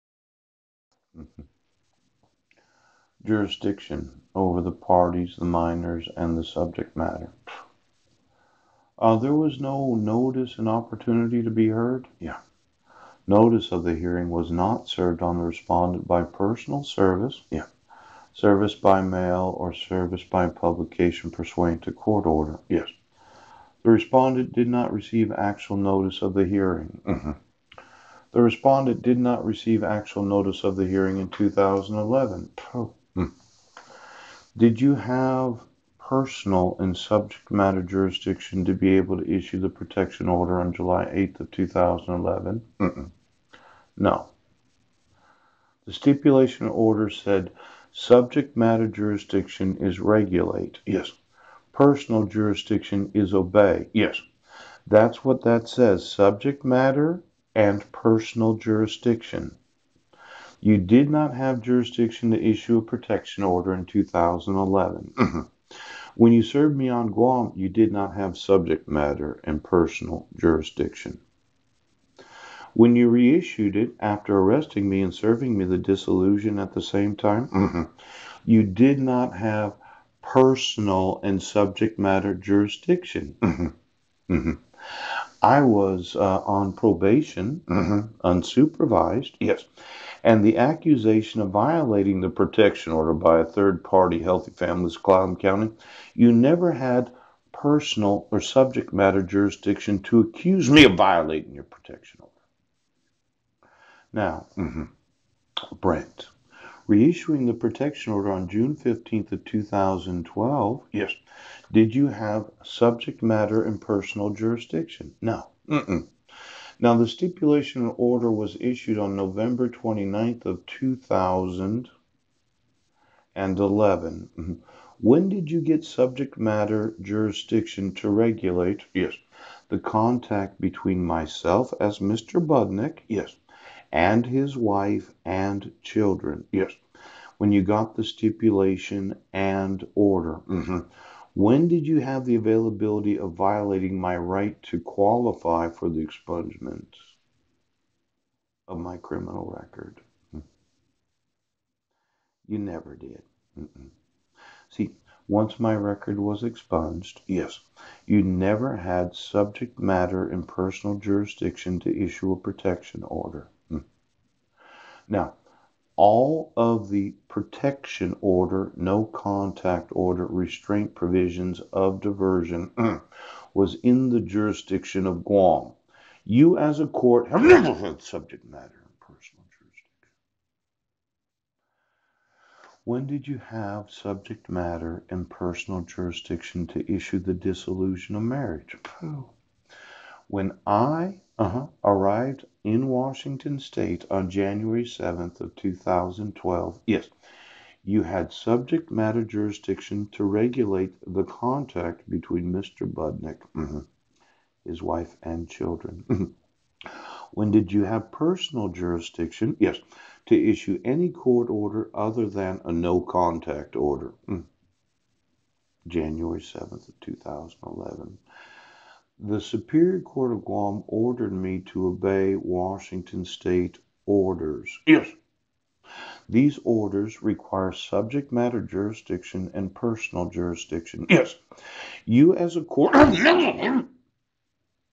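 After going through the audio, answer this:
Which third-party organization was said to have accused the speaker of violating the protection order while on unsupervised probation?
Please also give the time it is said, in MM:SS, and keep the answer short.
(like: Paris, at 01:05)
Healthy Families, at 01:34.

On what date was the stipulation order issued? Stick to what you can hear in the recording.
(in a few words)
November 29, 2011.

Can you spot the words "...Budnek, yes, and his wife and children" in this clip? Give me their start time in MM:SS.
02:12.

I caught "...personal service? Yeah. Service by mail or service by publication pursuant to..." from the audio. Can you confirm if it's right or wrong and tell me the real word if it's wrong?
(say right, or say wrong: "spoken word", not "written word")
right.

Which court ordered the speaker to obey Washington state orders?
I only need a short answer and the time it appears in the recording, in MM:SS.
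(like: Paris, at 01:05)
Superior Court of Guam, at 03:39.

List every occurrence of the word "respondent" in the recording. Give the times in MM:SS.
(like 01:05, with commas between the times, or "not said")
00:15, 00:23, 00:28.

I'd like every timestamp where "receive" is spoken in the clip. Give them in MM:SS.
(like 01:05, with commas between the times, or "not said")
00:24, 00:29.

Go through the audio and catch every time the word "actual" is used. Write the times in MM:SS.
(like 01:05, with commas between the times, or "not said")
00:25, 00:29.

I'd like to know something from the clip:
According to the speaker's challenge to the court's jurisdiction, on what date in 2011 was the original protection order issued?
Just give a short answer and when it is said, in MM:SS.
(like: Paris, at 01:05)
July 8, at 00:40.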